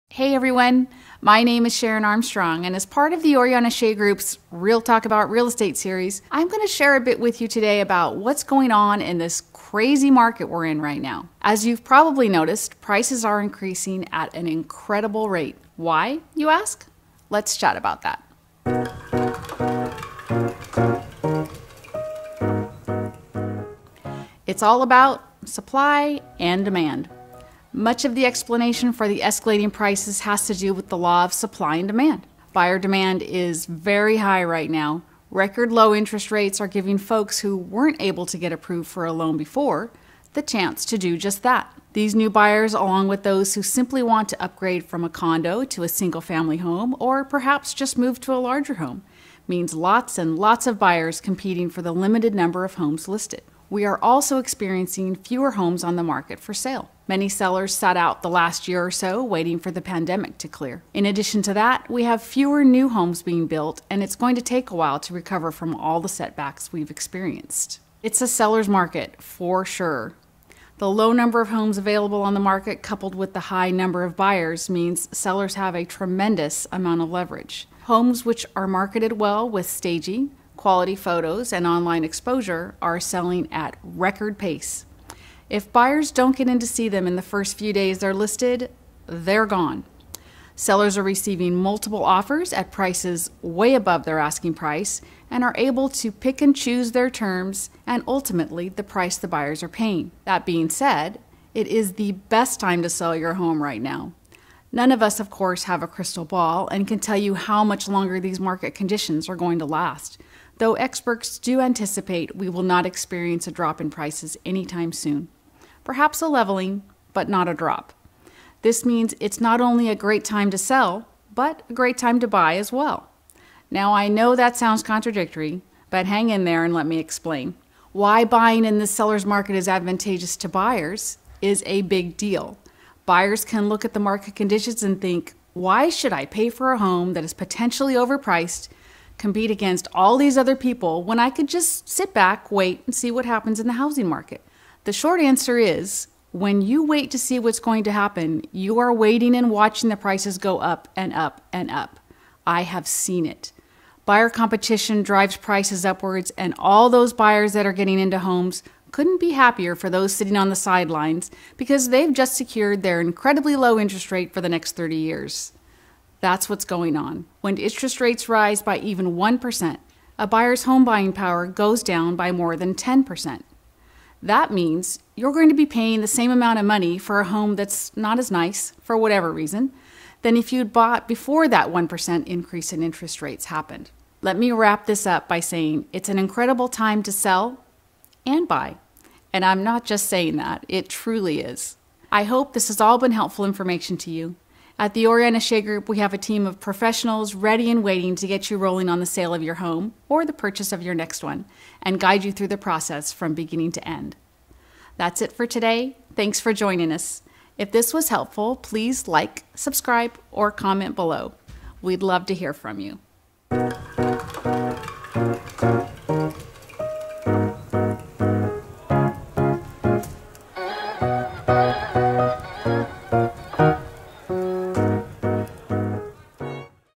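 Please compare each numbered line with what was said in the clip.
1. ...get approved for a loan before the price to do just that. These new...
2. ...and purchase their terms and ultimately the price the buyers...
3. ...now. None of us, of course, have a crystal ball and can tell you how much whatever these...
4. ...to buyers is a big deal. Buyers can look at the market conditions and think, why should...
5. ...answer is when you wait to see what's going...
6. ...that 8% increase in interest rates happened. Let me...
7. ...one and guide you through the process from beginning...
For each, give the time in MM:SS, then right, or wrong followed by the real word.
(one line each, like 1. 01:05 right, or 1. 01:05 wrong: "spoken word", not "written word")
1. 00:38 wrong: "chance", not "price"
2. 01:36 wrong: "choose", not "purchase"
3. 01:43 wrong: "longer", not "whatever"
4. 02:10 right
5. 02:25 right
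6. 03:01 wrong: "1", not "8"
7. 03:21 right.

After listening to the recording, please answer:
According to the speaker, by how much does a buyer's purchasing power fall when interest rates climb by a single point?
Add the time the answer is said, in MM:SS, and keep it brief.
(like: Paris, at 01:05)
more than 10%, at 02:52.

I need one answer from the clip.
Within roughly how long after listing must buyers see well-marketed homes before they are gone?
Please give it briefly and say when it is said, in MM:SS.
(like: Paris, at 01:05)
first few days, at 01:27.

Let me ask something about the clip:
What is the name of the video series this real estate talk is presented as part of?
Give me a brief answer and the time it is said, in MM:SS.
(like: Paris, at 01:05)
Real Talk About Real Estate, at 00:04.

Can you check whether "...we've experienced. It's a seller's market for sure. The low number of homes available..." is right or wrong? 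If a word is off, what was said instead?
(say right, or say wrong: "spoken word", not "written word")
right.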